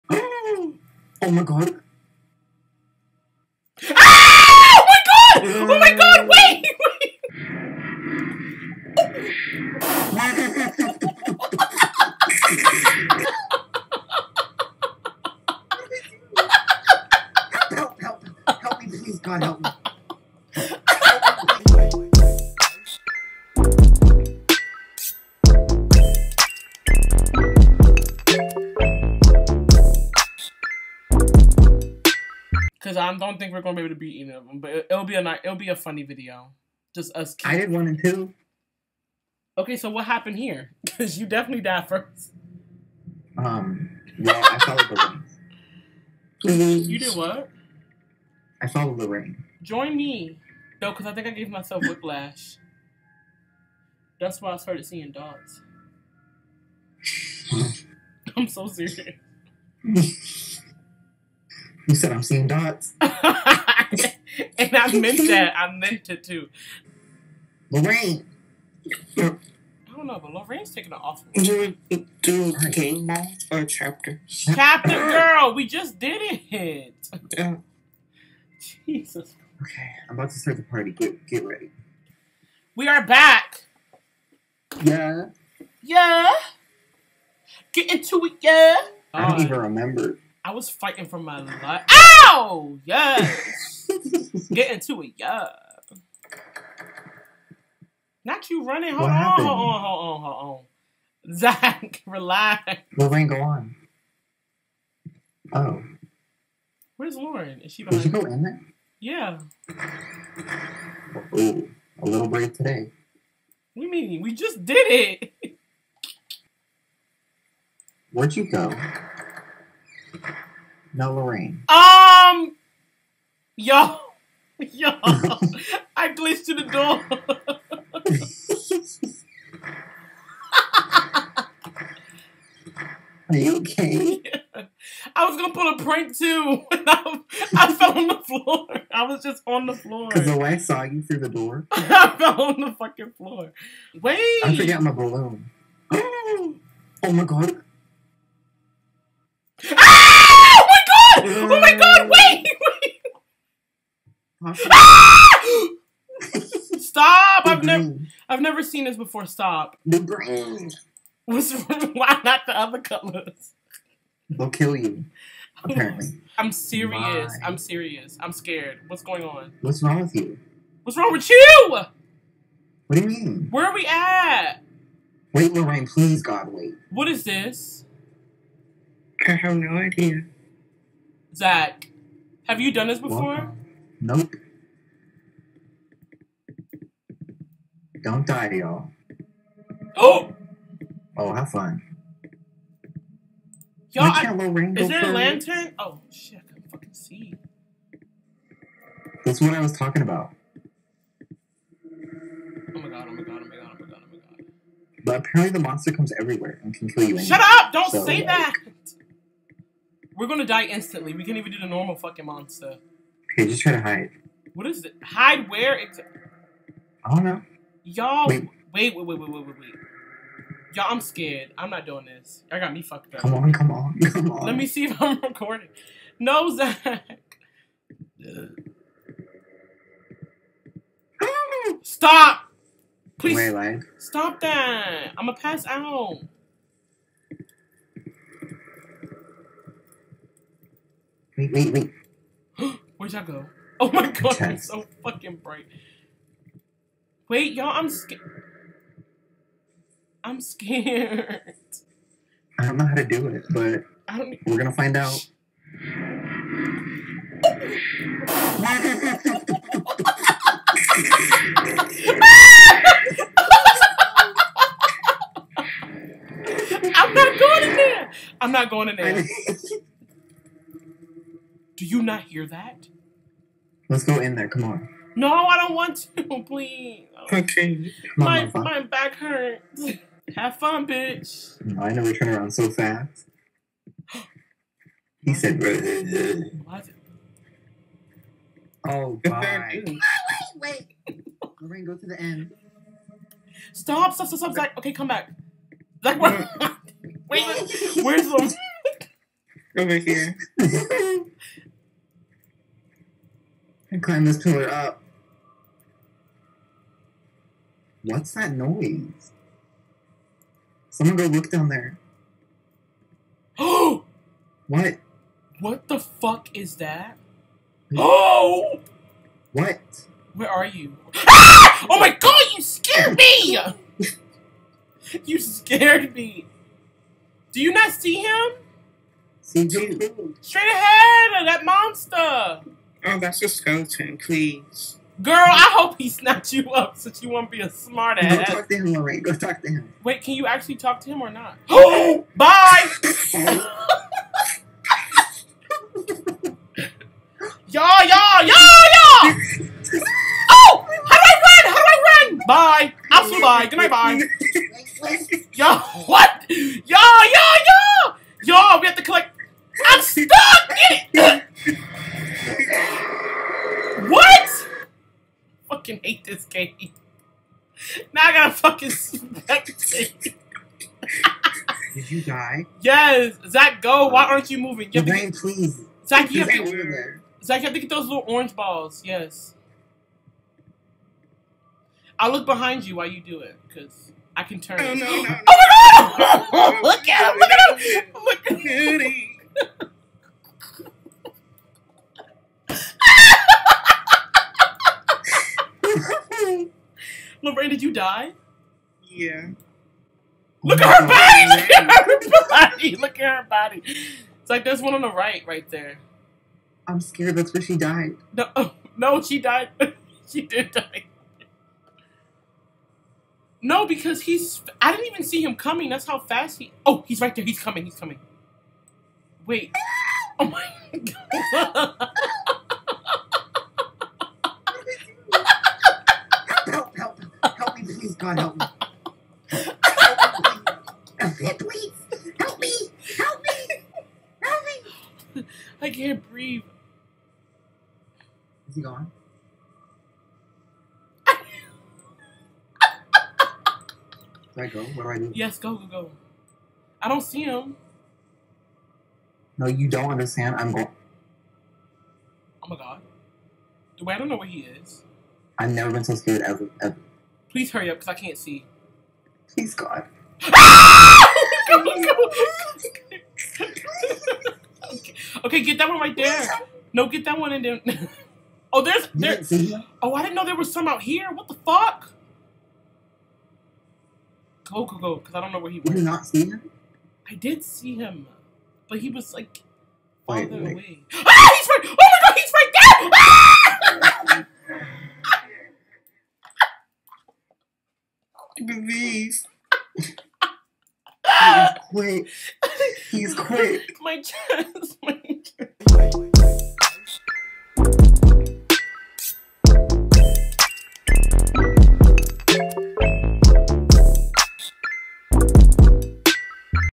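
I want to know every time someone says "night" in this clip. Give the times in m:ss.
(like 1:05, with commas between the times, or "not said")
0:35, 1:13, 5:53.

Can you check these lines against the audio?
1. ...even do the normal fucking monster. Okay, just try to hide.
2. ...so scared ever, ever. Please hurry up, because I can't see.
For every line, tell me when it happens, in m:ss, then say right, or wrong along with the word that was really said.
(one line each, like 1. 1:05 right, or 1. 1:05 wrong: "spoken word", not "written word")
1. 3:31 right
2. 7:36 right.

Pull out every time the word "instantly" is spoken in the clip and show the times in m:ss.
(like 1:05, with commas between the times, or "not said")
3:30.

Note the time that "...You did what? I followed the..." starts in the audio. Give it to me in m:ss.
0:46.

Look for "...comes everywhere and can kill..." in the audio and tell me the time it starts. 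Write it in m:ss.
3:25.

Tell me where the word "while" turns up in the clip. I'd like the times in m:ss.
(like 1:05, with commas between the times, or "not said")
6:22.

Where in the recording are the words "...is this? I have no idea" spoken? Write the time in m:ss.
2:57.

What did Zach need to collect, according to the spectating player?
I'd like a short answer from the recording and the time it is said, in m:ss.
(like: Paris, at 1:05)
Little orange balls, at 6:18.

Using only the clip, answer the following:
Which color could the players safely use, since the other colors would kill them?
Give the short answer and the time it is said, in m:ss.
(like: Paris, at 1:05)
Green, at 2:39.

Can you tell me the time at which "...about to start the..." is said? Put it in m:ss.
1:20.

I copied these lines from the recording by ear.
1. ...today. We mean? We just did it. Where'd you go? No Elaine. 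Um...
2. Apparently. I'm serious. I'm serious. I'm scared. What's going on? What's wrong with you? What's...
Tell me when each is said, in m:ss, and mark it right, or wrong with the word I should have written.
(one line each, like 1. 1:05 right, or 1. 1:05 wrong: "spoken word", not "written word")
1. 1:52 wrong: "Lorraine", not "Elaine"
2. 2:45 right.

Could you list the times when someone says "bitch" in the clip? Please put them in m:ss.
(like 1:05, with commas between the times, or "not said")
4:40.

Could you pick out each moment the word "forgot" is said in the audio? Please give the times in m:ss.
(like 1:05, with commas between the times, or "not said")
2:24.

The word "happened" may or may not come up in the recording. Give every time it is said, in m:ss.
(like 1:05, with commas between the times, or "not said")
0:40, 1:39.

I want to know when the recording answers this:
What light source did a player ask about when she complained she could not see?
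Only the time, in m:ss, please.
3:14.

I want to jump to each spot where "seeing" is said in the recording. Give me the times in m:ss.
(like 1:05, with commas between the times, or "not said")
0:54, 1:02.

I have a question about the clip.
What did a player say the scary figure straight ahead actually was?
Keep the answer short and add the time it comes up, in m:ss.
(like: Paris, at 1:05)
A skeleton, at 5:33.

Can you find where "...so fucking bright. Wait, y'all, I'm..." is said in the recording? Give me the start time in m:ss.
4:04.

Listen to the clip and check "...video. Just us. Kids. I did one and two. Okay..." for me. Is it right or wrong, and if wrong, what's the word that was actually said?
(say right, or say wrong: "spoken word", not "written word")
right.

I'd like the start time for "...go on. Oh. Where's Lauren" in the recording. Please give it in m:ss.
1:43.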